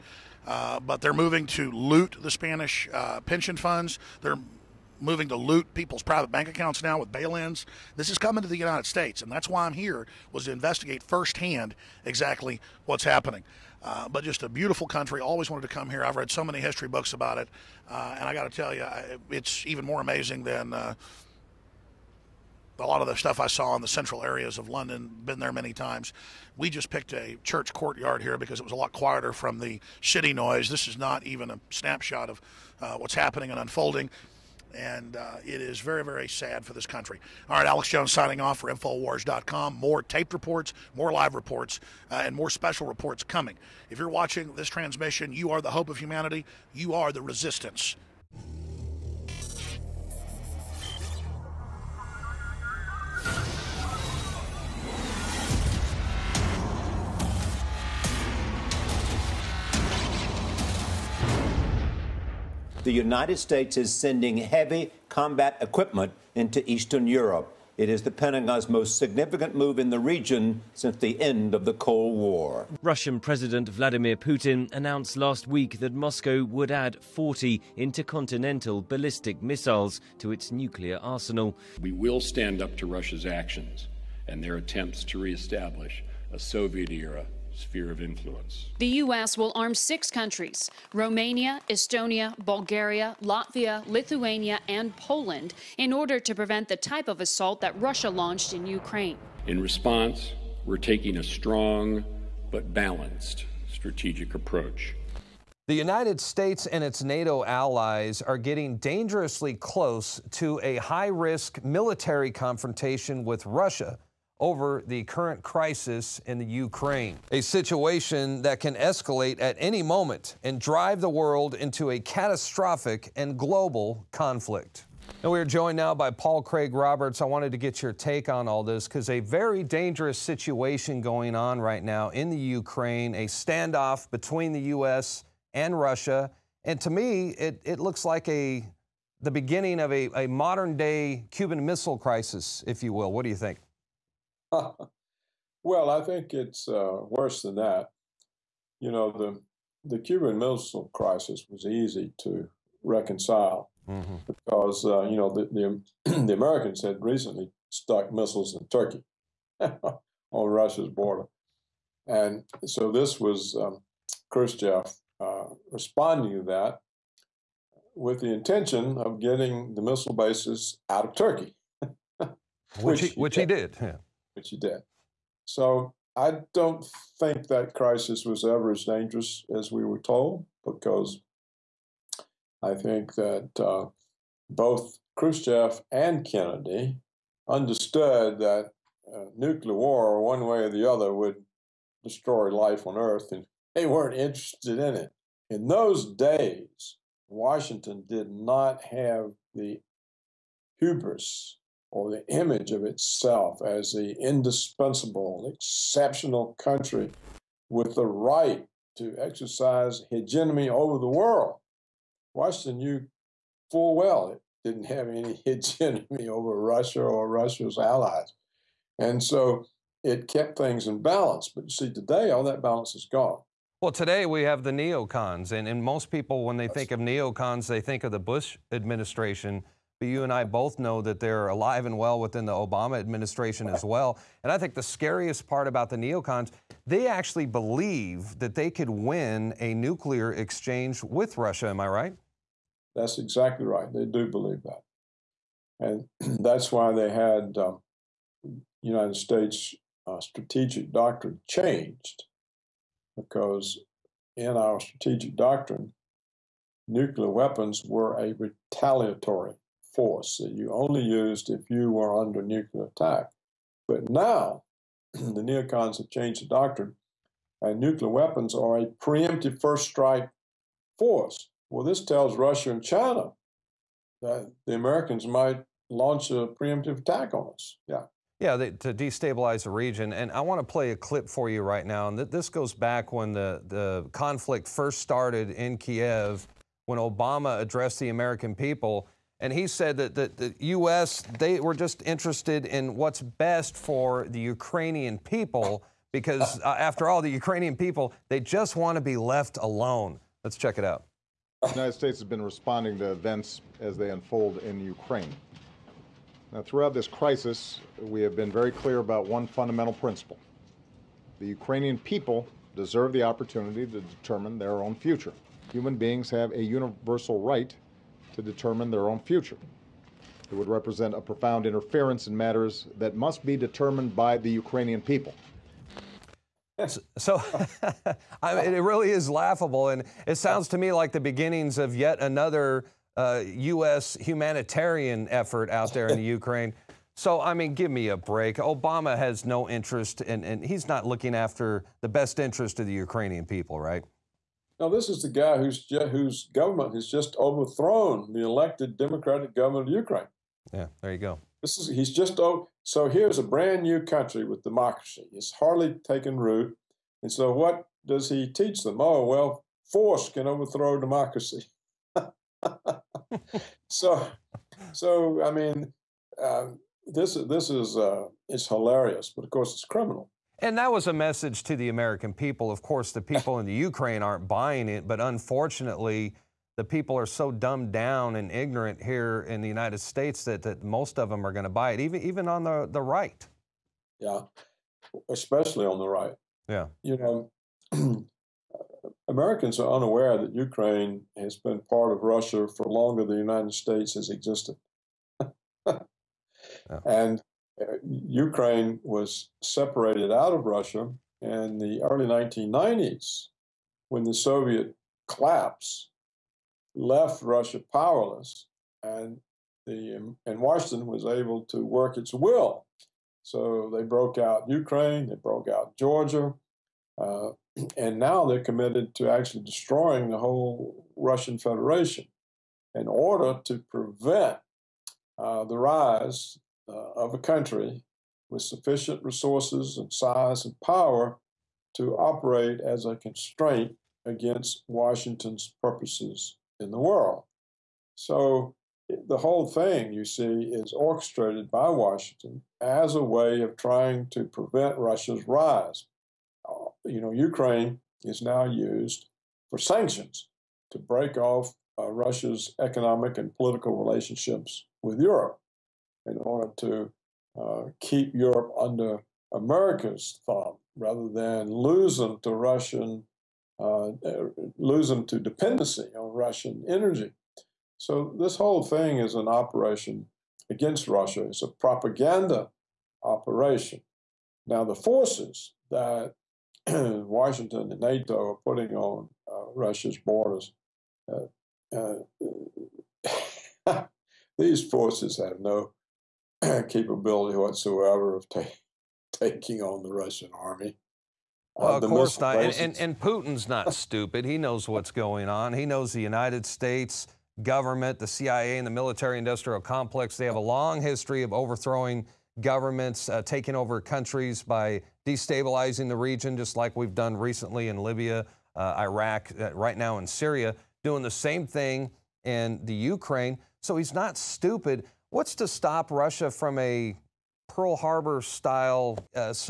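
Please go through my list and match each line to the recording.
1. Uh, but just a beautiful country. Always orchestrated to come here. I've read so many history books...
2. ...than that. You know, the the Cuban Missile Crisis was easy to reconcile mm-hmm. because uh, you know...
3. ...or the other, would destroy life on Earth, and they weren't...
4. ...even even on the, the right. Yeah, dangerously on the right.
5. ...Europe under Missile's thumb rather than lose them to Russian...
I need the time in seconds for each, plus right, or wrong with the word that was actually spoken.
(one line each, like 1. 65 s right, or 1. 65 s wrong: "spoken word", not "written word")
1. 13 s wrong: "wanted", not "orchestrated"
2. 147 s right
3. 190 s right
4. 381 s wrong: "especially", not "dangerously"
5. 458 s wrong: "America", not "Missile".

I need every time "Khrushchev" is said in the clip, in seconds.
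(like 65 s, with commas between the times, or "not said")
164 s, 185 s.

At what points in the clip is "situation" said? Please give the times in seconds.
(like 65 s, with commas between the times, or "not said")
117 s, 130 s.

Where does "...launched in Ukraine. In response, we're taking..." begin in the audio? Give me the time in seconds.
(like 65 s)
98 s.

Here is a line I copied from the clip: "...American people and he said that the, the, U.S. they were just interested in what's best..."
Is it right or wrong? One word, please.
right.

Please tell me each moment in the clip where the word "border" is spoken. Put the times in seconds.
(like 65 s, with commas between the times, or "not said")
160 s, 480 s.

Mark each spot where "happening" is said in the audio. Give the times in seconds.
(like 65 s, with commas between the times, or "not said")
13 s, 33 s.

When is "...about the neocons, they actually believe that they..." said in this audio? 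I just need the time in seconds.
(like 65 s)
235 s.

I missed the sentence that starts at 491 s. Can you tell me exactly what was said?
Uh, well, uh, of course not.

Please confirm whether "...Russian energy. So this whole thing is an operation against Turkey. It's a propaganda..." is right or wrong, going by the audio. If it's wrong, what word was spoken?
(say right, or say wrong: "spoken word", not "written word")
wrong: "Russia", not "Turkey".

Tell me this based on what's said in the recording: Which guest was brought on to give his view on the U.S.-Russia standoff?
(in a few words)
Paul Craig Roberts.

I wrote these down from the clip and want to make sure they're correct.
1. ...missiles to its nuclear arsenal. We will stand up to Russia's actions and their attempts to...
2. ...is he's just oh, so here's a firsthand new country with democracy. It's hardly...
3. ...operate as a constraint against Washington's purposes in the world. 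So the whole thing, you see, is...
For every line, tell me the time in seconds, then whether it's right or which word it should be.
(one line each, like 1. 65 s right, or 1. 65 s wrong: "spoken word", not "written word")
1. 79 s right
2. 351 s wrong: "brand", not "firsthand"
3. 432 s right.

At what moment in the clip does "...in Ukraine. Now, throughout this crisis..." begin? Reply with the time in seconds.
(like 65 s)
304 s.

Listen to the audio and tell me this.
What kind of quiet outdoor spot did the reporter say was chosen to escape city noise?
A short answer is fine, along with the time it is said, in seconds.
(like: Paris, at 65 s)
church courtyard, at 27 s.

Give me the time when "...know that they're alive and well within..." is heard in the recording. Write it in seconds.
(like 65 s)
230 s.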